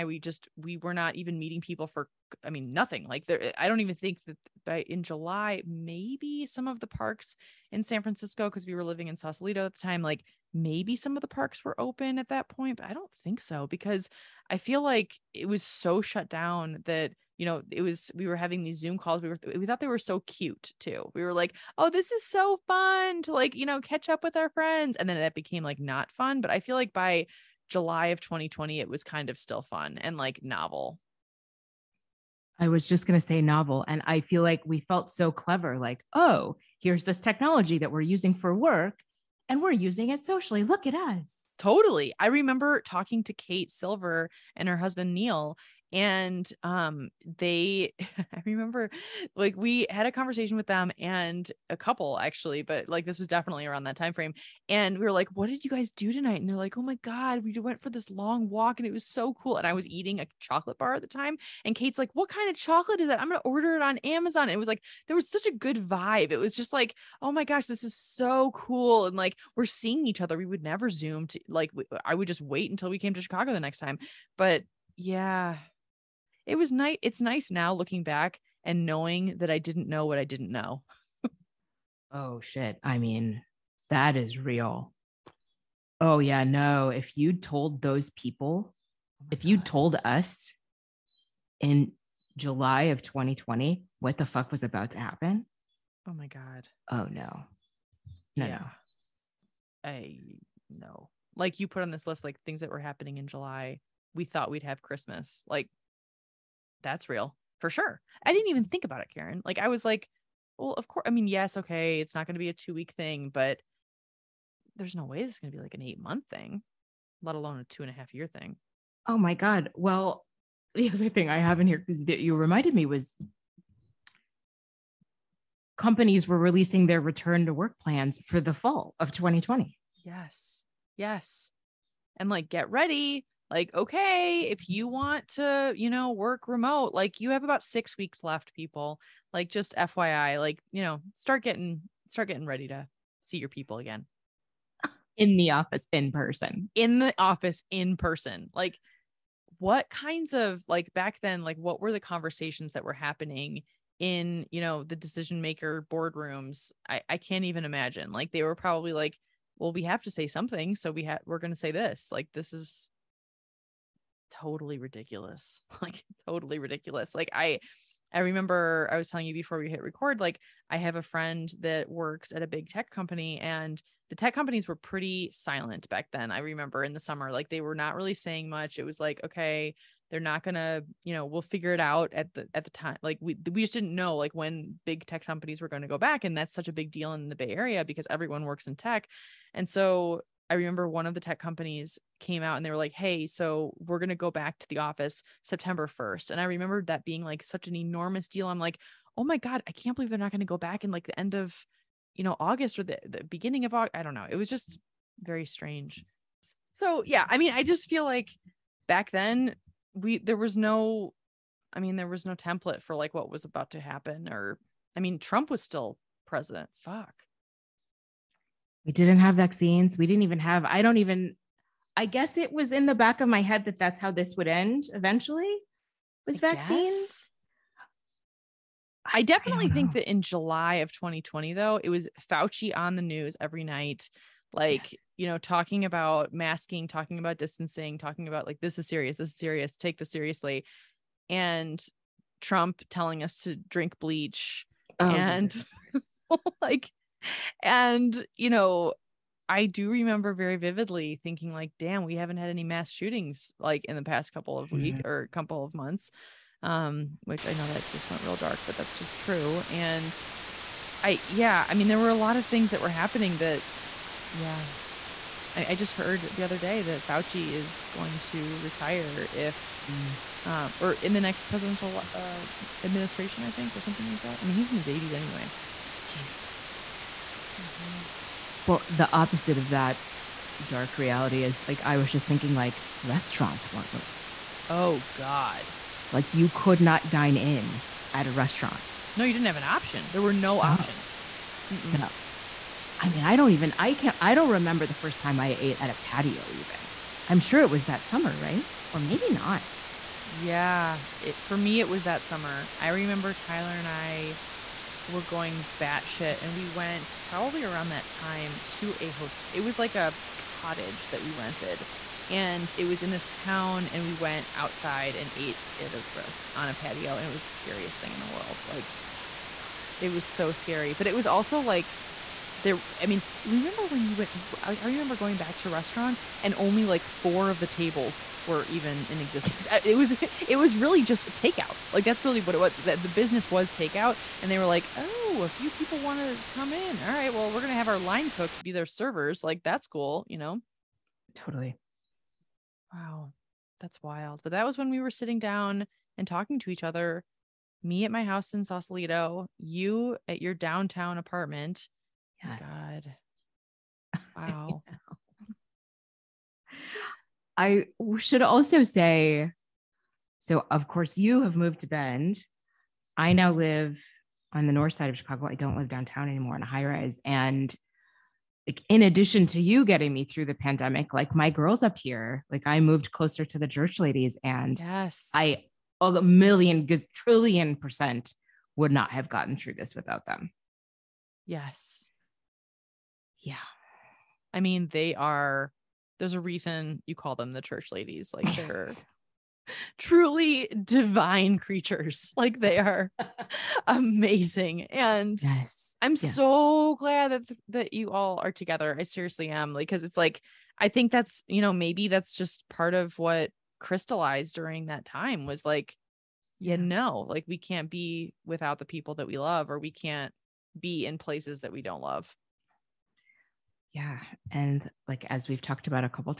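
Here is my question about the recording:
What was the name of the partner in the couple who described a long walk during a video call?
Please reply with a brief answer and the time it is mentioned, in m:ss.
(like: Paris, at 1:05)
Neil, at 0:45.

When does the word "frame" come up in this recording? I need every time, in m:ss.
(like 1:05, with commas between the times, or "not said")
0:54.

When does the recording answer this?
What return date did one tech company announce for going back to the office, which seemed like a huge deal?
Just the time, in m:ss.
3:15.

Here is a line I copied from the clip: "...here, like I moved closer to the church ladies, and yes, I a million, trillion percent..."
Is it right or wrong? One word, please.
right.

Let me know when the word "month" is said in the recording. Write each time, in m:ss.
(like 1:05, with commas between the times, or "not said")
1:56, 4:15.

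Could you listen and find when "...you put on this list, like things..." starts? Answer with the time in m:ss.
1:41.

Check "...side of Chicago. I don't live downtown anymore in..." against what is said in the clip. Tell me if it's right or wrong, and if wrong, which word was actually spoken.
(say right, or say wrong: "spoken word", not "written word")
right.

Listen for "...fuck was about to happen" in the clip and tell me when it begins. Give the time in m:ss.
1:34.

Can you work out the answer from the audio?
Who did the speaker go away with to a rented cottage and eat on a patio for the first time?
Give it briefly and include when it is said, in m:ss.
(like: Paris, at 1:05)
Tyler, at 5:03.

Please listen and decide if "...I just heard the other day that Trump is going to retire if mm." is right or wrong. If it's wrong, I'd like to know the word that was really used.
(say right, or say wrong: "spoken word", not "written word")
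wrong: "Fauci", not "Trump".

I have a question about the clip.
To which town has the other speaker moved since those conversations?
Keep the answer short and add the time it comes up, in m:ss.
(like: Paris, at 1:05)
Bend, at 6:01.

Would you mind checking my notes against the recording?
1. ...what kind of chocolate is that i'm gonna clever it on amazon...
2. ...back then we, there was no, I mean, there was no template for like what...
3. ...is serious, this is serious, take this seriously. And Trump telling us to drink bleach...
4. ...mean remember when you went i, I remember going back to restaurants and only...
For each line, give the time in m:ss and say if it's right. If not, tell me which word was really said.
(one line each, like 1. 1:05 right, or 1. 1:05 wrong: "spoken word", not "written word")
1. 1:02 wrong: "order", not "clever"
2. 3:28 right
3. 3:58 right
4. 5:23 right.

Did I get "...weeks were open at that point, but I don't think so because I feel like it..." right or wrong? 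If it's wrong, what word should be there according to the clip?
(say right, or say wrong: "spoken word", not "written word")
wrong: "parks", not "weeks".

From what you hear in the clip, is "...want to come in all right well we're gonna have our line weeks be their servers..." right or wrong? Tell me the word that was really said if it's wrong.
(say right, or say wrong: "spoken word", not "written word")
wrong: "cooks", not "weeks".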